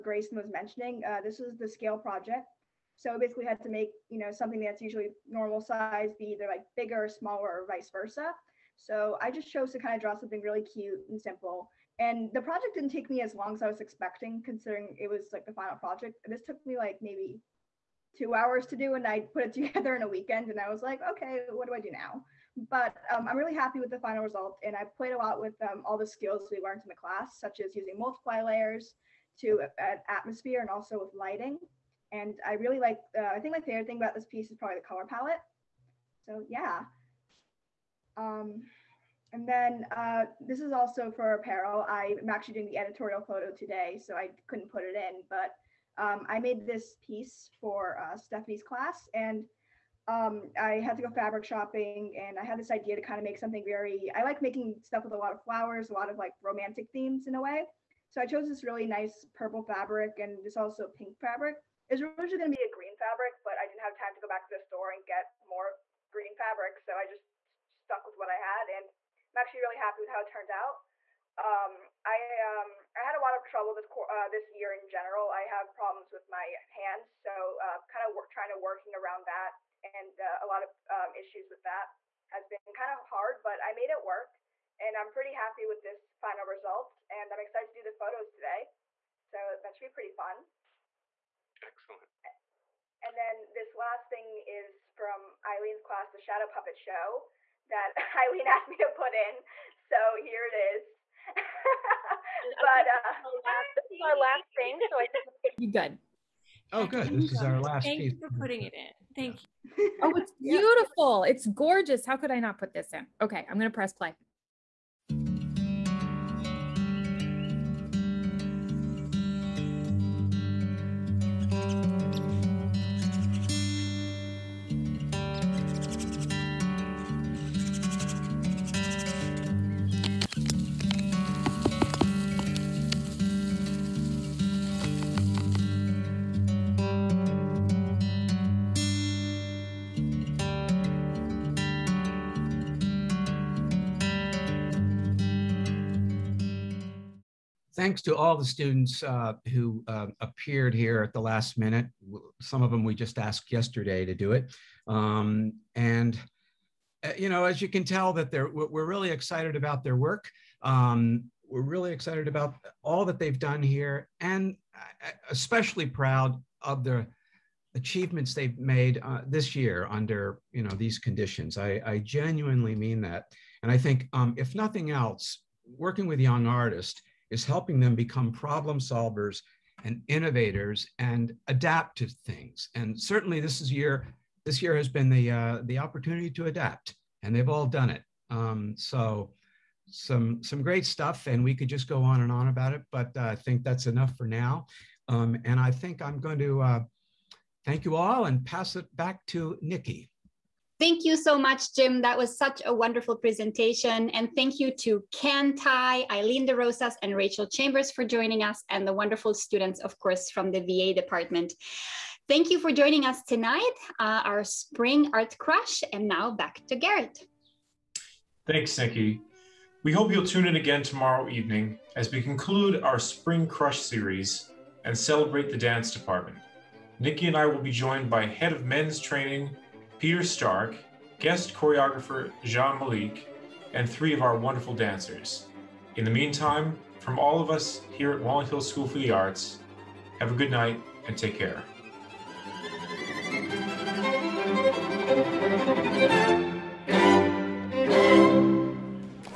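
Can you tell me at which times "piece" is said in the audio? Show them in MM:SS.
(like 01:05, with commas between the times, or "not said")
00:34, 00:47, 01:48.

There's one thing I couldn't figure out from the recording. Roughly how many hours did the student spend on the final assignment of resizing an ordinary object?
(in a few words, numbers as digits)
2 hours.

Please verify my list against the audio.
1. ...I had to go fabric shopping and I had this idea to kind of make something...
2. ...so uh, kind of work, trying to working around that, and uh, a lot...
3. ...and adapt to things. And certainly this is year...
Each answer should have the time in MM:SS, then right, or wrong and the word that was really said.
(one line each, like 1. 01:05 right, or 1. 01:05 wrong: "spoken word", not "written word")
1. 00:50 right
2. 01:17 right
3. 03:00 right.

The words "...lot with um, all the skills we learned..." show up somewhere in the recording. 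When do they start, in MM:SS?
00:25.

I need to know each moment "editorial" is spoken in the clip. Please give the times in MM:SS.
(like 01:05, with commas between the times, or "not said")
00:42.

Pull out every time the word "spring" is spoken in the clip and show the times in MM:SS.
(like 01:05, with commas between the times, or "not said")
03:34, 03:42.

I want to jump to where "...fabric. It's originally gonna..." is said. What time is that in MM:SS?
01:01.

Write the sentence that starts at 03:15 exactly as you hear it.
Um, and I think I'm going to uh, thank you all and pass it back to Nikki.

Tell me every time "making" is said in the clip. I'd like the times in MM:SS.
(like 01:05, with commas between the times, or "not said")
00:54.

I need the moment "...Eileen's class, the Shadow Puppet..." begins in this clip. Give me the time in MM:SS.
01:35.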